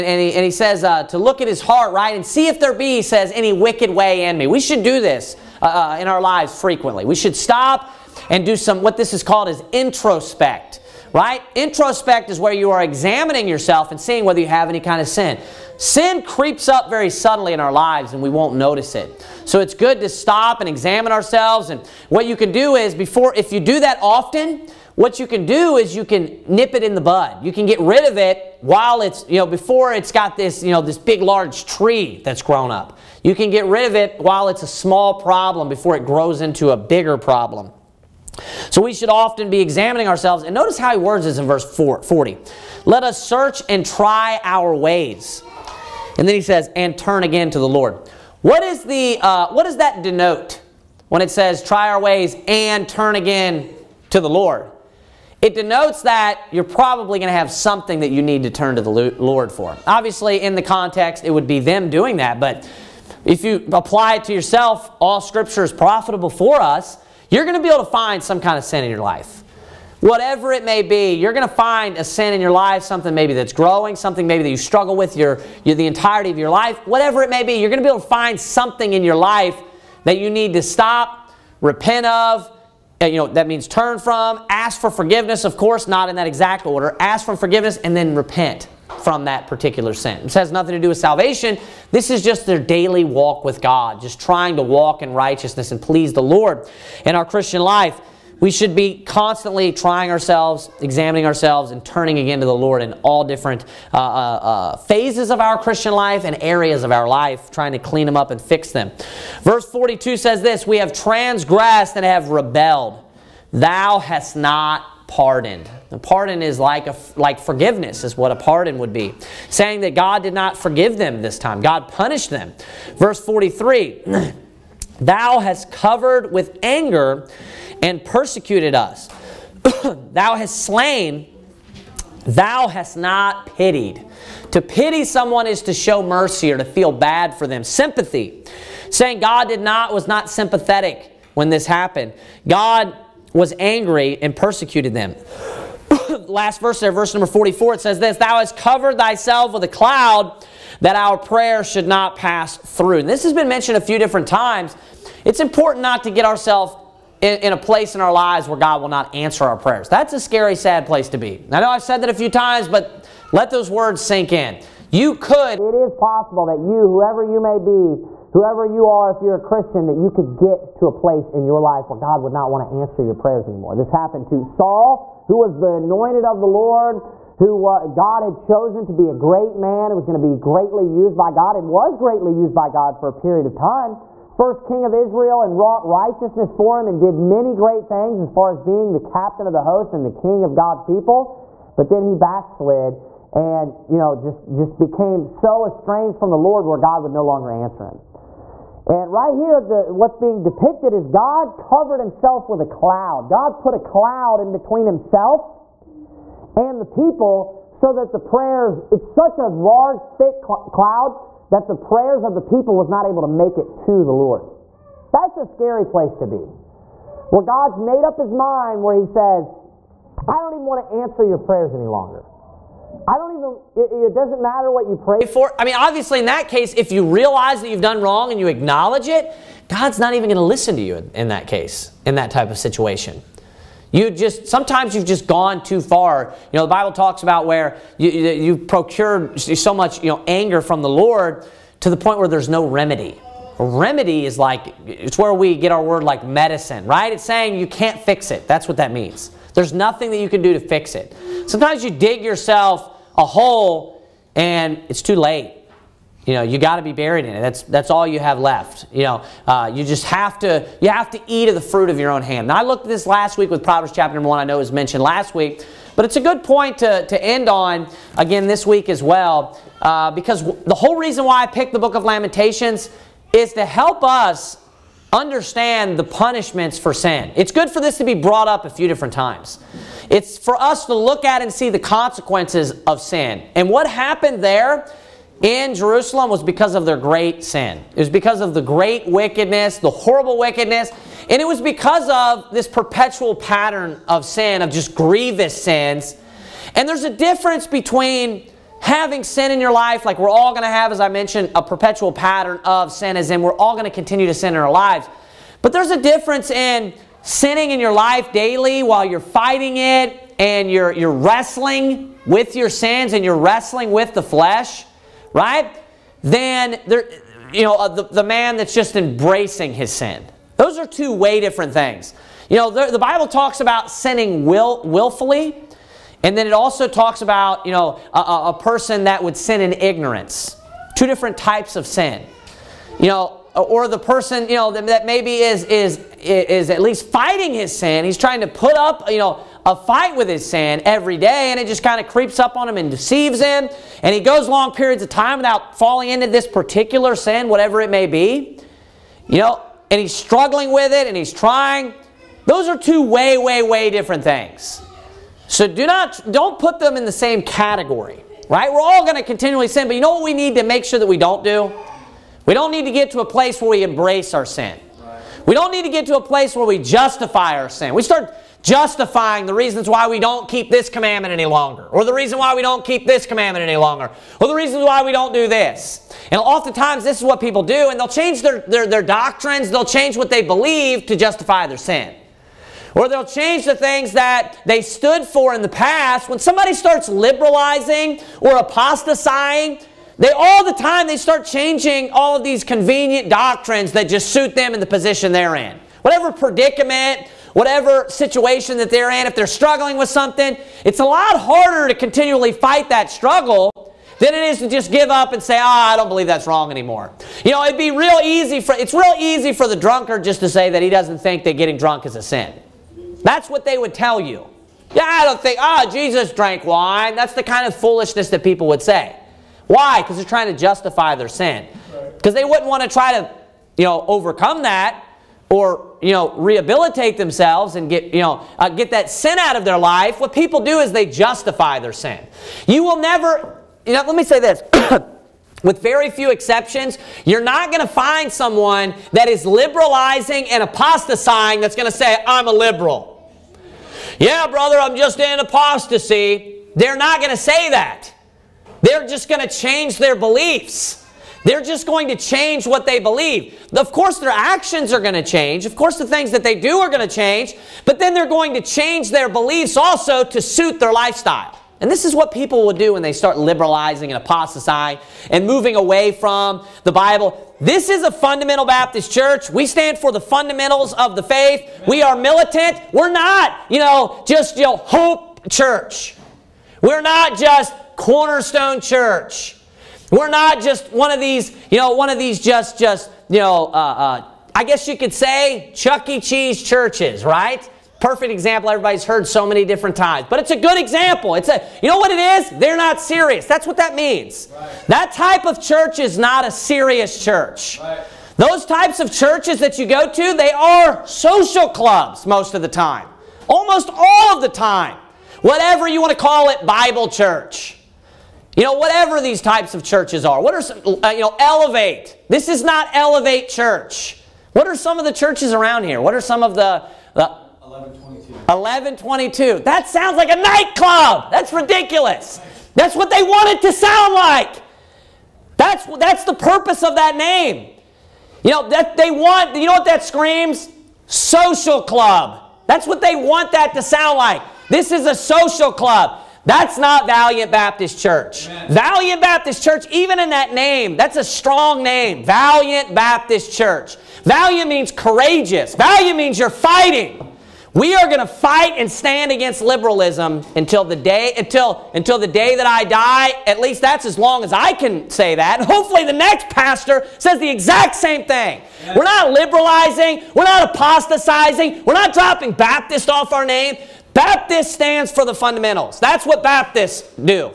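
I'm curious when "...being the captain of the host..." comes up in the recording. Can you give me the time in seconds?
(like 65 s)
188 s.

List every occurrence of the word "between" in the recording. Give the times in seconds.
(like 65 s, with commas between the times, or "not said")
204 s, 297 s.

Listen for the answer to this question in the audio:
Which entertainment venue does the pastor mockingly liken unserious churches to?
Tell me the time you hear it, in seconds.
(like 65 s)
485 s.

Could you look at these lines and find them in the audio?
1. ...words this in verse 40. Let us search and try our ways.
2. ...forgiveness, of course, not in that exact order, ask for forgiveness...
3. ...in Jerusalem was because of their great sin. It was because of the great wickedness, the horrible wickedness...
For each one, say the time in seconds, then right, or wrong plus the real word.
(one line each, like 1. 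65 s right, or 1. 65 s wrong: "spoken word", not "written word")
1. 40 s right
2. 84 s right
3. 285 s right.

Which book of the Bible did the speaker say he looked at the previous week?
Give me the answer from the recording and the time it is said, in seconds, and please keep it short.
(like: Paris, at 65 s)
Proverbs, at 263 s.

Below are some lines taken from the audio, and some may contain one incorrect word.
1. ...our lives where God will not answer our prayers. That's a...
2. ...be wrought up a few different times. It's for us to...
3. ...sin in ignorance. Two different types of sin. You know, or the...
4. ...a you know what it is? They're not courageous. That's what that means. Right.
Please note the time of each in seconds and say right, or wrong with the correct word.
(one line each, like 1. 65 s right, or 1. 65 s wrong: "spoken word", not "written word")
1. 158 s right
2. 278 s wrong: "brought", not "wrought"
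3. 329 s right
4. 491 s wrong: "serious", not "courageous".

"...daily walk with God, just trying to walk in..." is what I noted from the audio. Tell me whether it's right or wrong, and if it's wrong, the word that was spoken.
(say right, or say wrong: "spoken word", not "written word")
right.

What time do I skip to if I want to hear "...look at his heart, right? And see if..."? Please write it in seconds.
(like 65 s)
1 s.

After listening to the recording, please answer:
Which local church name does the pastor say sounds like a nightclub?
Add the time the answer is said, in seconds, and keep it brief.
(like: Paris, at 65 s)
1122, at 518 s.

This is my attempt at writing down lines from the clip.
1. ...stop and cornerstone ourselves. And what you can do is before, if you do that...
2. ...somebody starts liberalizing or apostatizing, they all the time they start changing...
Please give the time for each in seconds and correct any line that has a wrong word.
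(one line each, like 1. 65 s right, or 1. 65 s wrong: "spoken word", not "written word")
1. 20 s wrong: "examine", not "cornerstone"
2. 386 s right.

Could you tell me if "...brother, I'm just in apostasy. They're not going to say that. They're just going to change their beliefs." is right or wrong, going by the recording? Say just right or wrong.
right.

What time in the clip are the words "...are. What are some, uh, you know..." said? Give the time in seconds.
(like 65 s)
510 s.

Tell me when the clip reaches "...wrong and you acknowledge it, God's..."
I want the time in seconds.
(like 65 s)
228 s.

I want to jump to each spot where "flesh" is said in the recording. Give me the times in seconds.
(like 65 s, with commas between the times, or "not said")
314 s.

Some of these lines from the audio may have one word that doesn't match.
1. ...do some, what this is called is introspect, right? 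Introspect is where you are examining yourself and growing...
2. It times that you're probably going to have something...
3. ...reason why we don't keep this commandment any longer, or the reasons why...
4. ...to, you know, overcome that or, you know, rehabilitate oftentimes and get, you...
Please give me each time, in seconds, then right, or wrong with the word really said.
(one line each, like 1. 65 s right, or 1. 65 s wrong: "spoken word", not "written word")
1. 8 s wrong: "seeing", not "growing"
2. 55 s wrong: "denotes", not "times"
3. 372 s right
4. 423 s wrong: "themselves", not "oftentimes".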